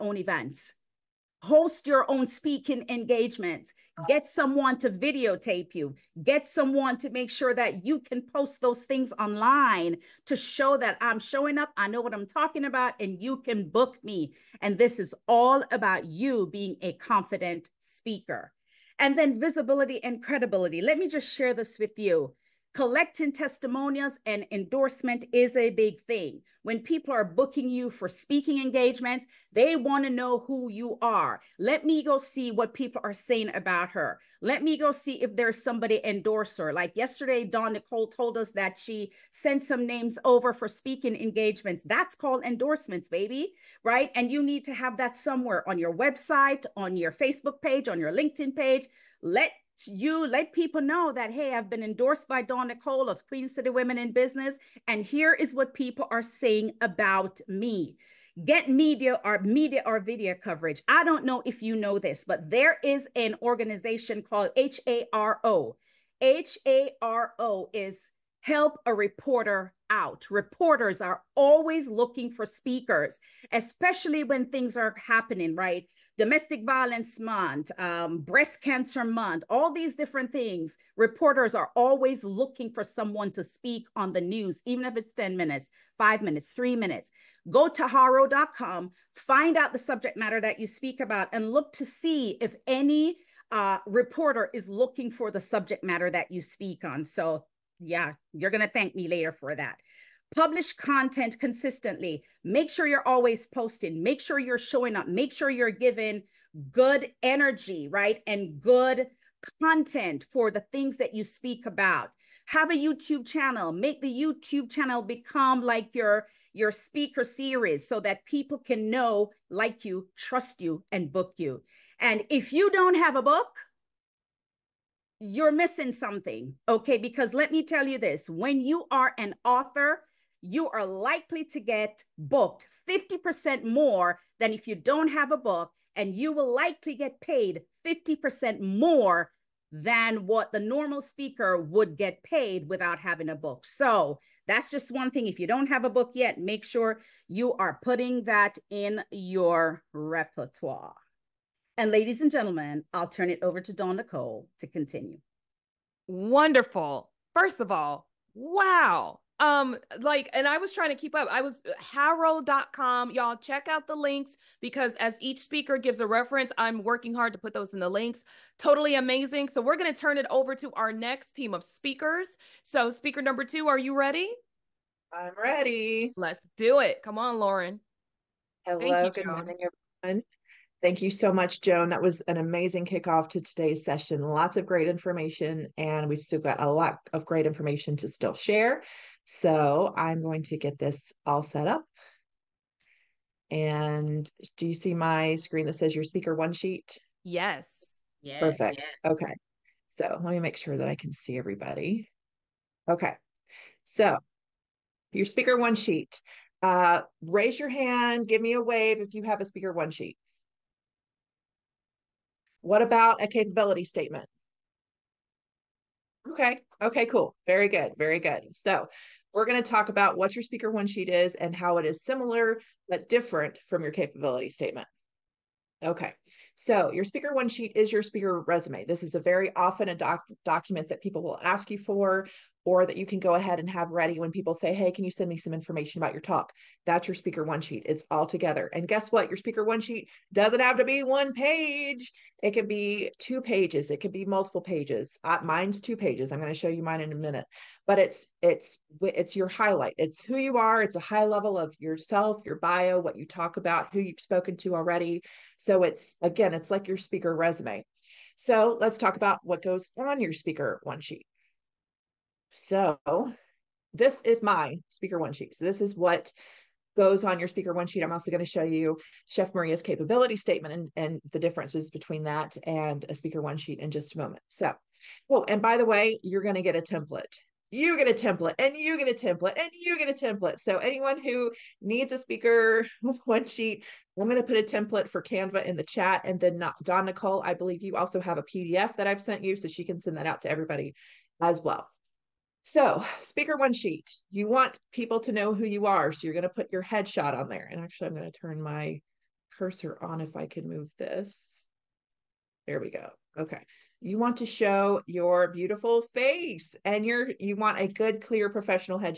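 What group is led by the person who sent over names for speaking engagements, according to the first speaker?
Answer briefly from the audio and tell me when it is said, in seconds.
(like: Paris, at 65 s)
Queen City Women in Business, at 53 s.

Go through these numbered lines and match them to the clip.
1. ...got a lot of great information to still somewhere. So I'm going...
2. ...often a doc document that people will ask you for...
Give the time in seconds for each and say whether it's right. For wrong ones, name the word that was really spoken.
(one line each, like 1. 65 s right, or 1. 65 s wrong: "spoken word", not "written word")
1. 186 s wrong: "share", not "somewhere"
2. 229 s right.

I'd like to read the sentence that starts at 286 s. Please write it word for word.
And then not, Dawn Nicole, I believe you also have a PDF that I've sent you.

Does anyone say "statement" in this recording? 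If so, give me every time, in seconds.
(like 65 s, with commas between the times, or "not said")
213 s, 224 s, 270 s.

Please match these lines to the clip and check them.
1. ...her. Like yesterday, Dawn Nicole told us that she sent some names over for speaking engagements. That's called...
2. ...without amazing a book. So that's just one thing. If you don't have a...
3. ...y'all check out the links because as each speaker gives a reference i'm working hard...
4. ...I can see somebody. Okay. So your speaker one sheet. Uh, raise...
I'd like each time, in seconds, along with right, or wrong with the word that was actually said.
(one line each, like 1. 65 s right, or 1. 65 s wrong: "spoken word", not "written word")
1. 36 s right
2. 142 s wrong: "having", not "amazing"
3. 163 s right
4. 200 s wrong: "everybody", not "somebody".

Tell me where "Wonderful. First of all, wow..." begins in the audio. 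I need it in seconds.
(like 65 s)
156 s.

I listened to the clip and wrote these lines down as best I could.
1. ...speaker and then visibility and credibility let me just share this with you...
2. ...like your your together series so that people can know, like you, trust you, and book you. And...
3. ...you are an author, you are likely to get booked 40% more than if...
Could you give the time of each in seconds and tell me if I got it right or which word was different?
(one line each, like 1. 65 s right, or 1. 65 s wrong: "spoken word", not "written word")
1. 17 s right
2. 115 s wrong: "speaker", not "together"
3. 128 s wrong: "50", not "40".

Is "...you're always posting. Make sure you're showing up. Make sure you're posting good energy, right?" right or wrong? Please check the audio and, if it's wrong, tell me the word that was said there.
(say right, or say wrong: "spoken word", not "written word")
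wrong: "giving", not "posting".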